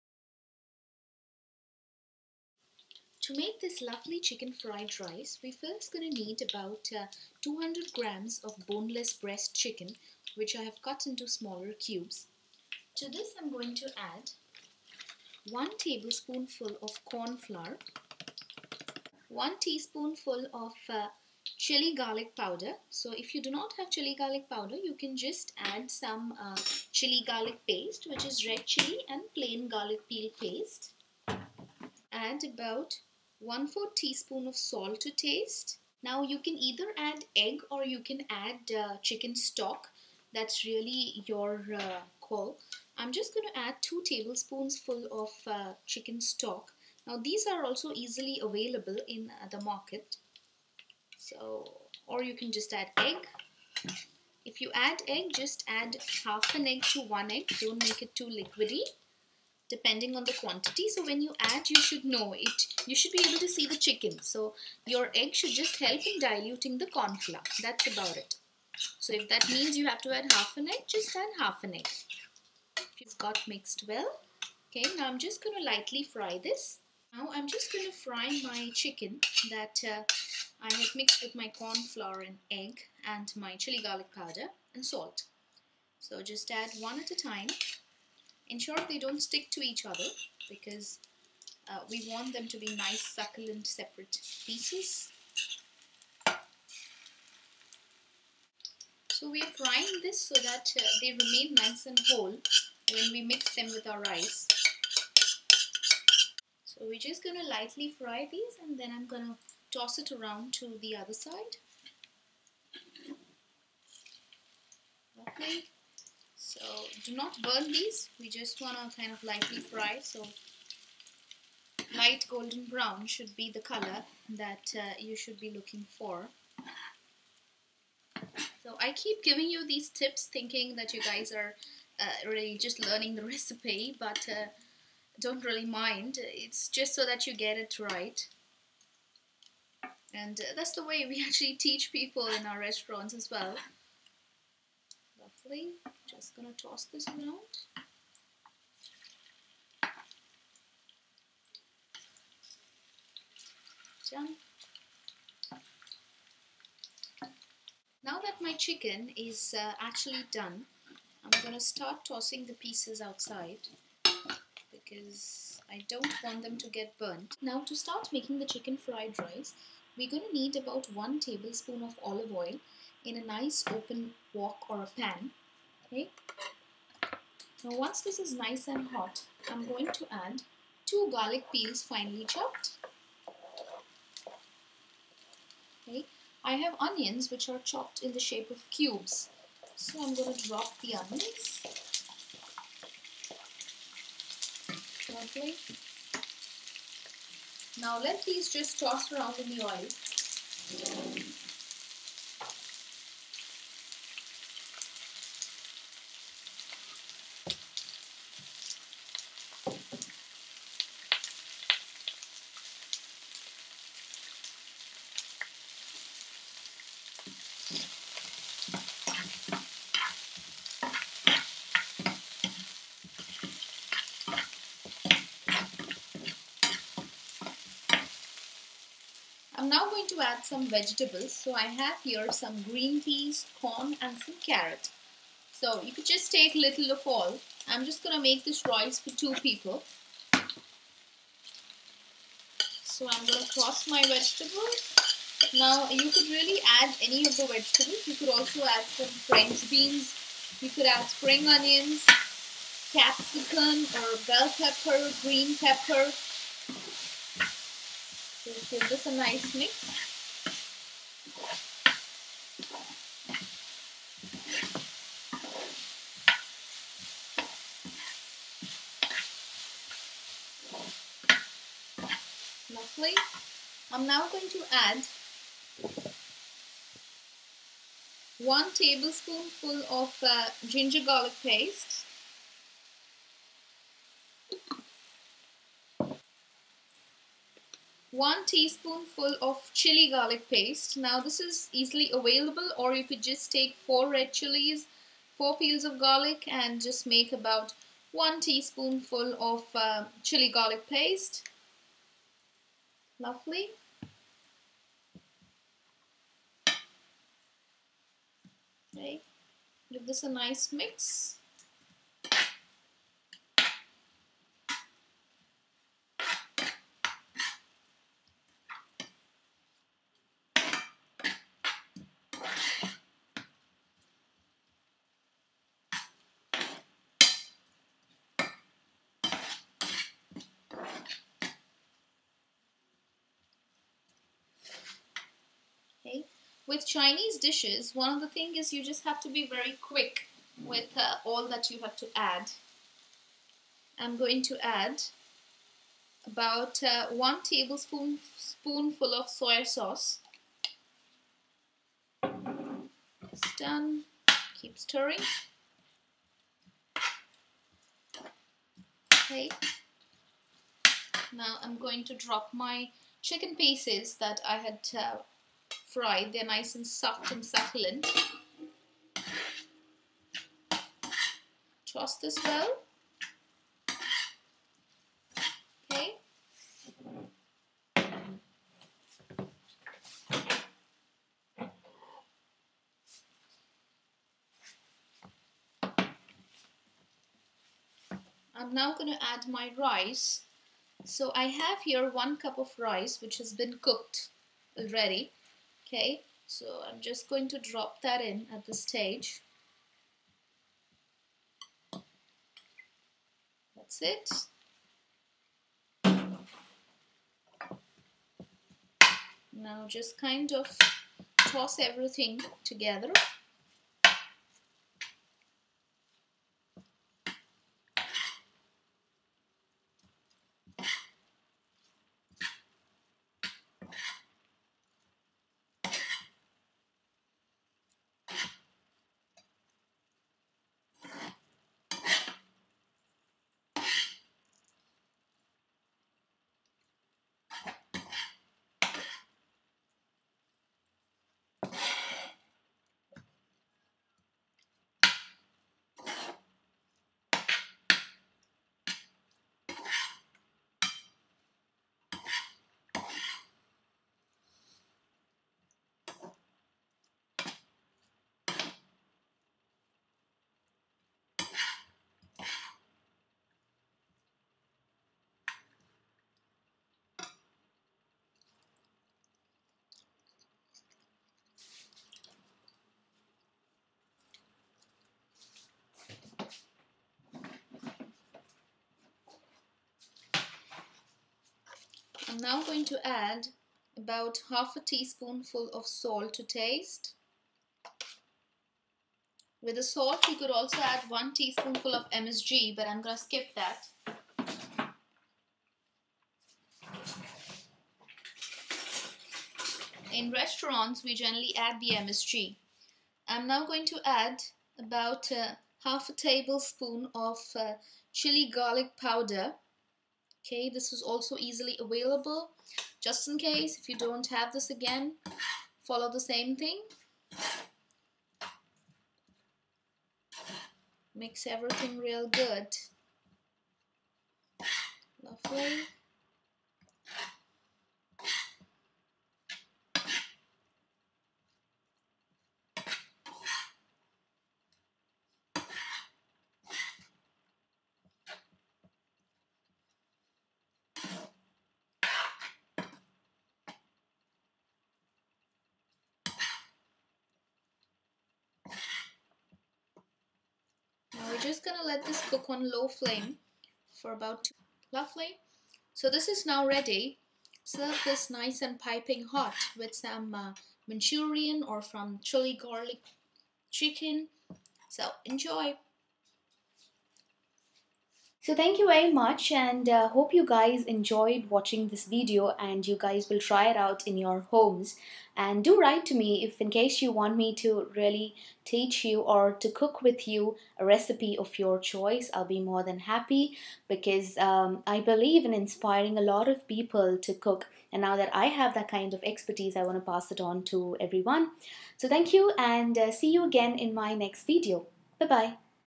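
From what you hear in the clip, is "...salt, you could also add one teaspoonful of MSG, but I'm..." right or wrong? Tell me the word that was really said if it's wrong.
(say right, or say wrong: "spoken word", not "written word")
right.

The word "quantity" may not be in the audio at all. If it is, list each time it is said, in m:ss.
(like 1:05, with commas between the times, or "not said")
1:00.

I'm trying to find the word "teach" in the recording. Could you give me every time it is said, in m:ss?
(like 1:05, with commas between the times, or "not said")
2:21, 9:38.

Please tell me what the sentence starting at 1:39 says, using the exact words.
So we are frying this so that uh, they remain nice and whole when we mix them with our rice.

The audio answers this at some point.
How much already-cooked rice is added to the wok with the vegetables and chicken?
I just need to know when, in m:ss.
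6:32.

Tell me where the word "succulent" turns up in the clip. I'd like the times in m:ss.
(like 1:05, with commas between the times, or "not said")
1:33, 6:07.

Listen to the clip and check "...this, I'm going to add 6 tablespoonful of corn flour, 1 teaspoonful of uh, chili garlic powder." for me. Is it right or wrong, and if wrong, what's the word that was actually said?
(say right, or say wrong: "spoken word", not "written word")
wrong: "1", not "6".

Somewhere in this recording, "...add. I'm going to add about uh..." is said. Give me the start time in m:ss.
5:42.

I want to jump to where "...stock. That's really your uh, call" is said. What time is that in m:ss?
0:39.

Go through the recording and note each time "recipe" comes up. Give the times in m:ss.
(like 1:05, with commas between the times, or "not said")
2:13, 9:40.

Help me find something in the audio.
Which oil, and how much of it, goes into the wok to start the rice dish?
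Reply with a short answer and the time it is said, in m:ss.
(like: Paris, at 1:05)
1 tablespoon of olive oil, at 2:50.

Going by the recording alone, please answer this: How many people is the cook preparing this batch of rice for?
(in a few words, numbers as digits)
2.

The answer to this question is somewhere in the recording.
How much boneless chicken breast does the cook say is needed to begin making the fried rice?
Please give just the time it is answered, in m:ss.
0:07.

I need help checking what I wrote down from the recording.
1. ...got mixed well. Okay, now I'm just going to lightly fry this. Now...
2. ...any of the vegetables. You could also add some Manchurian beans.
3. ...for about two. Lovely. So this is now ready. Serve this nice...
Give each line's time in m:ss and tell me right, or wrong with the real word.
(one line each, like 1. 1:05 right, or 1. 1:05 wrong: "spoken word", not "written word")
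1. 1:13 right
2. 4:07 wrong: "French", not "Manchurian"
3. 9:13 right.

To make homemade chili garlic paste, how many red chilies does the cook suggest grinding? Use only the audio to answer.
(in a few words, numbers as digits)
4.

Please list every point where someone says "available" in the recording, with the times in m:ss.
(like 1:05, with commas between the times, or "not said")
0:48, 4:52, 8:31.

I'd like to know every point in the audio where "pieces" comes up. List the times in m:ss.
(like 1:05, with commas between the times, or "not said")
1:34, 2:42, 6:03.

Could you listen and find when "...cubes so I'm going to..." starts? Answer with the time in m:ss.
3:08.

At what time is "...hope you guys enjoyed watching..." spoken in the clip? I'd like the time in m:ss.
9:30.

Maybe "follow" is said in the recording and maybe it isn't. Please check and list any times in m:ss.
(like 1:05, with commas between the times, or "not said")
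8:35.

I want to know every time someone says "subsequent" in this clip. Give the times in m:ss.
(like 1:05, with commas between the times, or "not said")
not said.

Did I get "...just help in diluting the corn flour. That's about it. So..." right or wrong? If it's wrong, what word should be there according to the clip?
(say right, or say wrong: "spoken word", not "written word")
right.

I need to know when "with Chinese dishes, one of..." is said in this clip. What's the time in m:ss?
5:36.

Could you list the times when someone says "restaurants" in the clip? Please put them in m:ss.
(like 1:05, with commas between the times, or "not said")
2:22, 8:20.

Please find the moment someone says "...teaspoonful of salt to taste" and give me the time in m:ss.
8:04.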